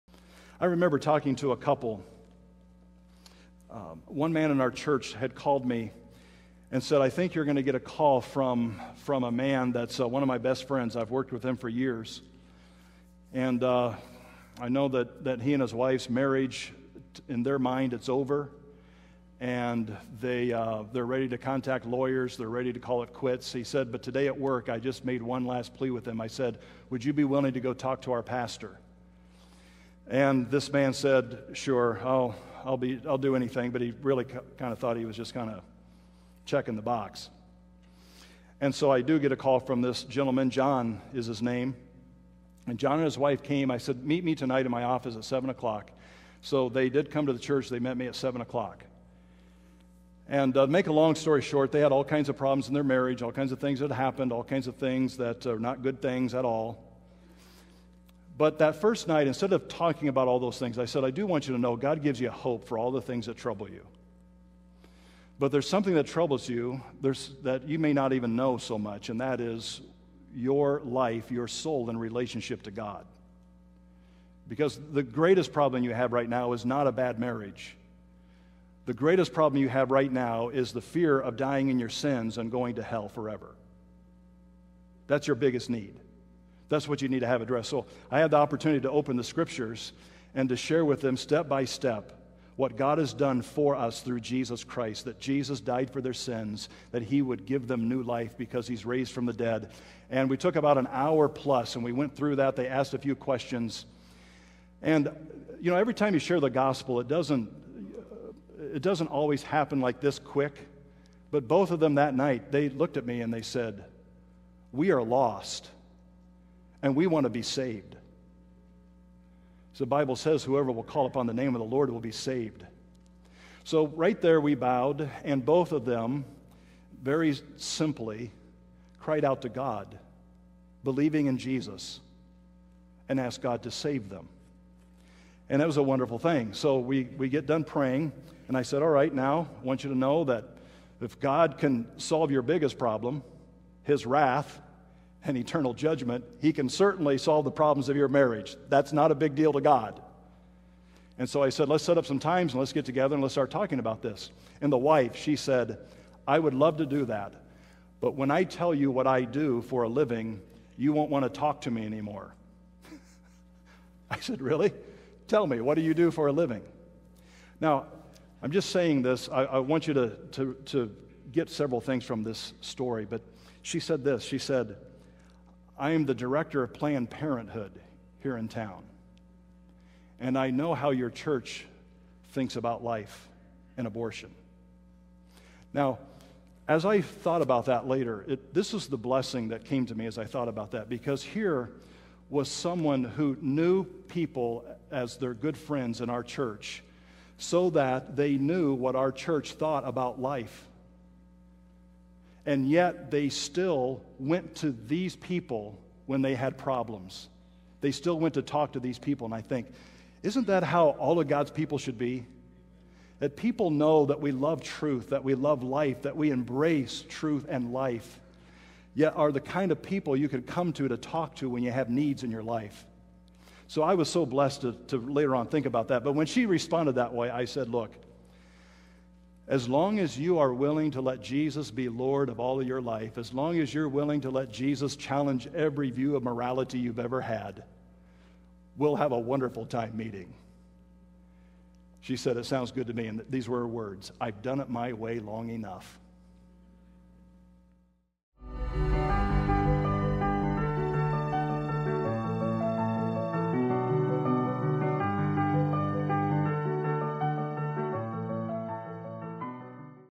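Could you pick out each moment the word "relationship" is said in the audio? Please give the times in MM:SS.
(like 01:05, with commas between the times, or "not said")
01:11.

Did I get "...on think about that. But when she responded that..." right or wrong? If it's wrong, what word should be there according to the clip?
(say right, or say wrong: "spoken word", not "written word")
right.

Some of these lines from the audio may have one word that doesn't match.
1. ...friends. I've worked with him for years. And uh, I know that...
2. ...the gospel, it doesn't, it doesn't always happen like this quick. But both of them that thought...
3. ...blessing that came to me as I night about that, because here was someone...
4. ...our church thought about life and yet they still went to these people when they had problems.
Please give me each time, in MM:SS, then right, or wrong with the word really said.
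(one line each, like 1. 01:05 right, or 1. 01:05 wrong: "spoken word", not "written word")
1. 00:10 right
2. 01:46 wrong: "night", not "thought"
3. 03:08 wrong: "thought", not "night"
4. 03:18 right.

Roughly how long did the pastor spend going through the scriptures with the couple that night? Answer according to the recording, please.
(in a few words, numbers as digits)
About an hour plus.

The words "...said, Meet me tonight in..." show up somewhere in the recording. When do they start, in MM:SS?
00:43.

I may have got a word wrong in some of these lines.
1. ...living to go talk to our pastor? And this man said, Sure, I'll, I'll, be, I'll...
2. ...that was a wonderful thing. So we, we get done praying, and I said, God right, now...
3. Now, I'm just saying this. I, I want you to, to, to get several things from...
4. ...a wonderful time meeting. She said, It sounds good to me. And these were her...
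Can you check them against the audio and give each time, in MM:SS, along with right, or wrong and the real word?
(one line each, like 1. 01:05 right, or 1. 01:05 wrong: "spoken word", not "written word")
1. 00:27 wrong: "willing", not "living"
2. 02:15 wrong: "All", not "God"
3. 02:47 right
4. 03:59 right.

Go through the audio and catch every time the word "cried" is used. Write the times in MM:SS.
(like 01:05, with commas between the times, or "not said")
02:08.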